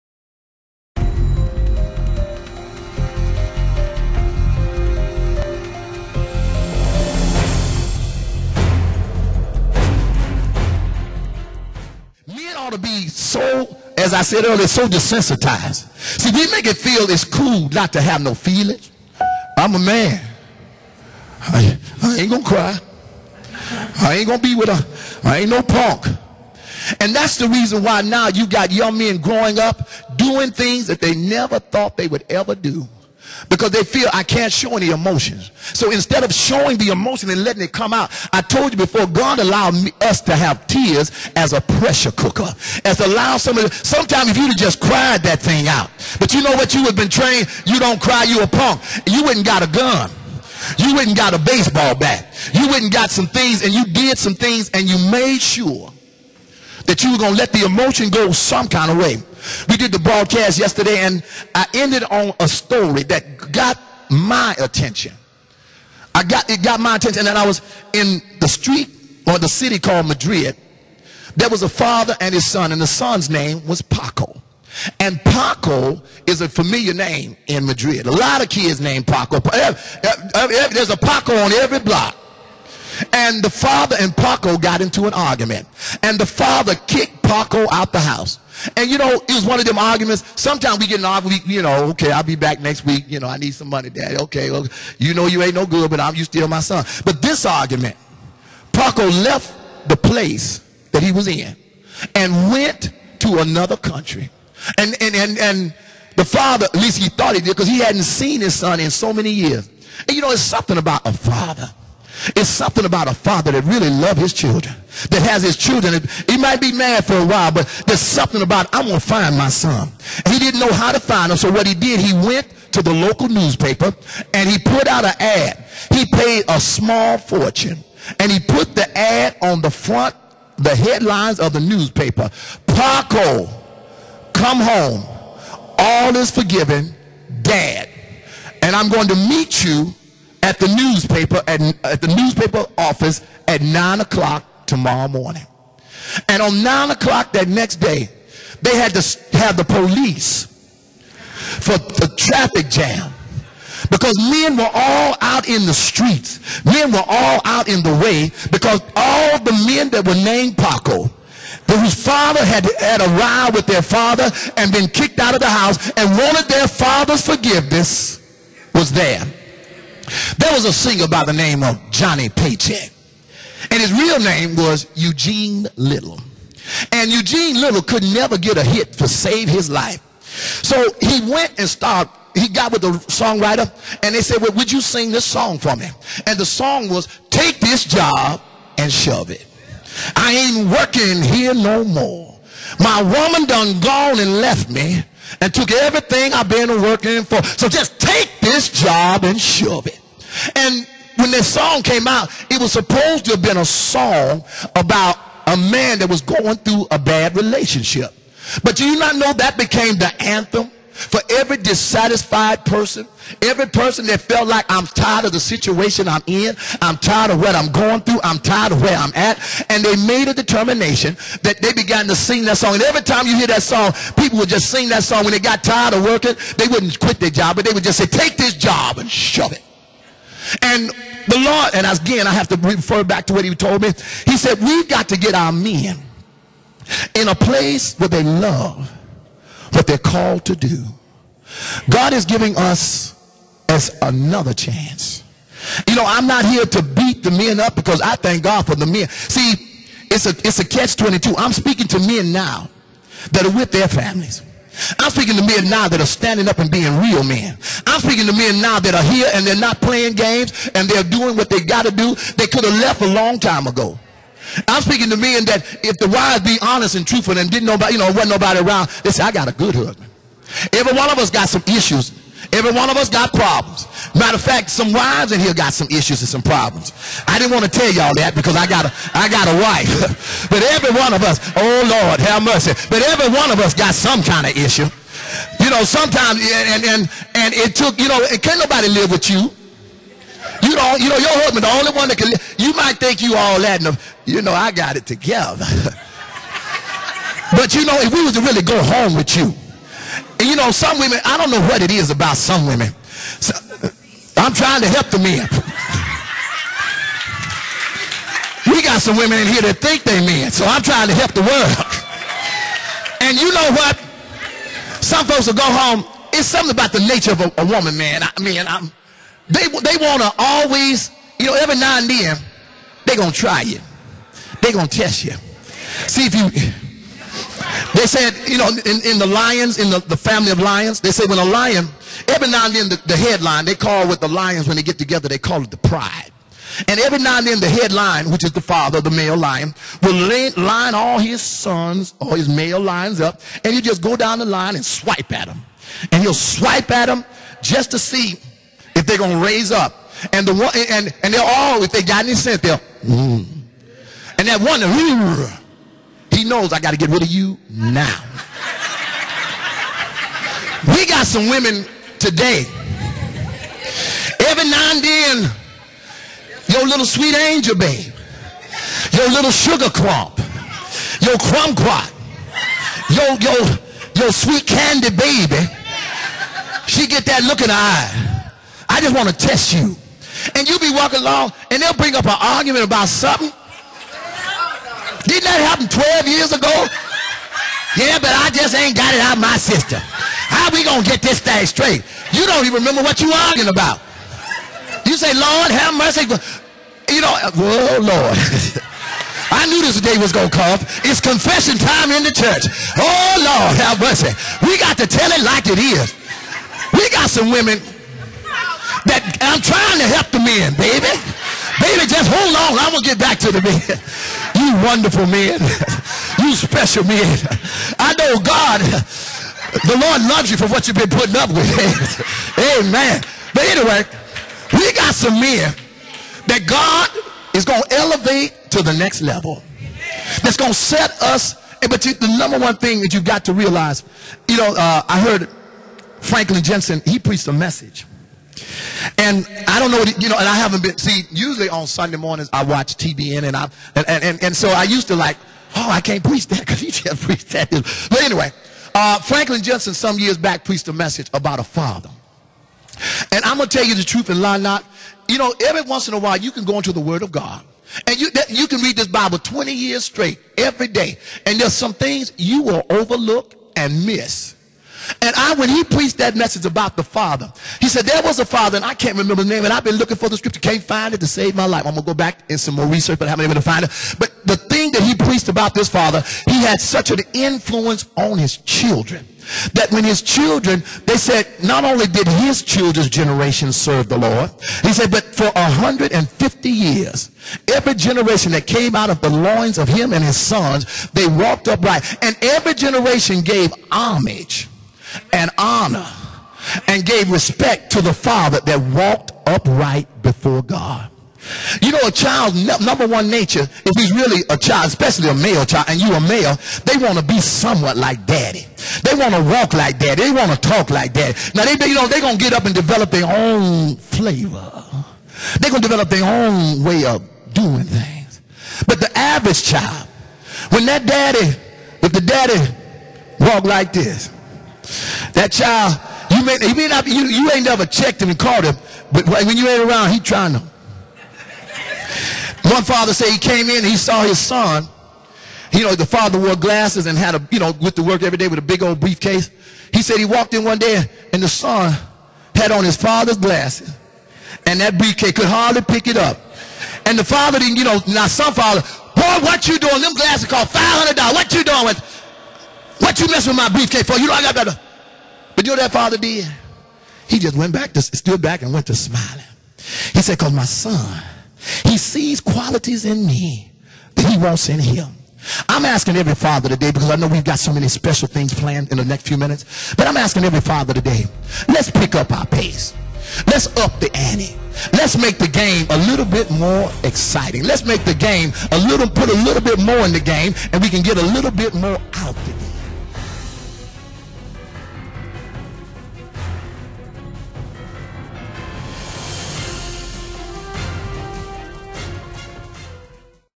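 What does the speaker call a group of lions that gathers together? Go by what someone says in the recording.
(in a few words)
the pride.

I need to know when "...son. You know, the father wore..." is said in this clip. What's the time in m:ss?
8:54.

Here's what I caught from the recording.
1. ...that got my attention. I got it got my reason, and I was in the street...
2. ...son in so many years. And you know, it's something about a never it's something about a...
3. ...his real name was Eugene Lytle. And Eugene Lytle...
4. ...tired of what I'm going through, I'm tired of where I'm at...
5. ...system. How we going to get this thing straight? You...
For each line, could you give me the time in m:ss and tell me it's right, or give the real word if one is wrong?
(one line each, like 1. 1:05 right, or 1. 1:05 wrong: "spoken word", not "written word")
1. 1:03 wrong: "attention", not "reason"
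2. 1:48 wrong: "father", not "never"
3. 2:53 right
4. 3:36 right
5. 6:29 right.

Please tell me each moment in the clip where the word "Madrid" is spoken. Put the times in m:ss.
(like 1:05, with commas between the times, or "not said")
1:10, 1:17.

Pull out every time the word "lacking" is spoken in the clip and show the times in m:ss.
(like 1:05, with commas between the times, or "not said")
not said.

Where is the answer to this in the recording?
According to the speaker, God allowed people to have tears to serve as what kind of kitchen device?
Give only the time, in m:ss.
0:41.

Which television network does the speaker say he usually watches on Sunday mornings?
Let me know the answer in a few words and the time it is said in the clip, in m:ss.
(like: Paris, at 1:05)
TBN, at 7:22.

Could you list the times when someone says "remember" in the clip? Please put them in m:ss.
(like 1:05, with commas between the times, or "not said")
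6:32, 7:49.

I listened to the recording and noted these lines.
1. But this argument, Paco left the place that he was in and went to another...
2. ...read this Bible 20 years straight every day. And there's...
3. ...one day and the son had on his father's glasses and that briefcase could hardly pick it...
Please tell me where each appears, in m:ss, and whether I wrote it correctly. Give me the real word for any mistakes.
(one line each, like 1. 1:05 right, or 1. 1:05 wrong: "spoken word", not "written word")
1. 1:37 right
2. 7:38 right
3. 9:00 right.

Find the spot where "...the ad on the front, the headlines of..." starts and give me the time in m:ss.
2:08.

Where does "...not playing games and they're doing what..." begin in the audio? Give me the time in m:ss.
4:19.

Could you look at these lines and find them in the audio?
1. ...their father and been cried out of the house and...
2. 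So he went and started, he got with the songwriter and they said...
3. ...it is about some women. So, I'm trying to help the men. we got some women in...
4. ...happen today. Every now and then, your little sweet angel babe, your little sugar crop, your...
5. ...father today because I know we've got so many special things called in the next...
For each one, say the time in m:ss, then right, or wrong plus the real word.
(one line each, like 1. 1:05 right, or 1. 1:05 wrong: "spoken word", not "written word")
1. 2:43 wrong: "kicked", not "cried"
2. 3:00 right
3. 5:01 right
4. 6:01 wrong: "women", not "happen"
5. 9:26 wrong: "planned", not "called".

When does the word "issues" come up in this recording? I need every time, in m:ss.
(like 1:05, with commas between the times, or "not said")
4:31, 4:35, 4:44.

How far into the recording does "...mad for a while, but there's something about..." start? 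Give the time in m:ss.
1:56.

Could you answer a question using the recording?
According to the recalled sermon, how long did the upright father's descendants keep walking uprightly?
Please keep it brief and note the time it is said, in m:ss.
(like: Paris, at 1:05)
150 years, at 8:05.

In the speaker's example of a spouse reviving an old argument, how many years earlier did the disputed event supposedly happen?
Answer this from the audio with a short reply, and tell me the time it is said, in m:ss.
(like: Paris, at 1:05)
12 years, at 6:25.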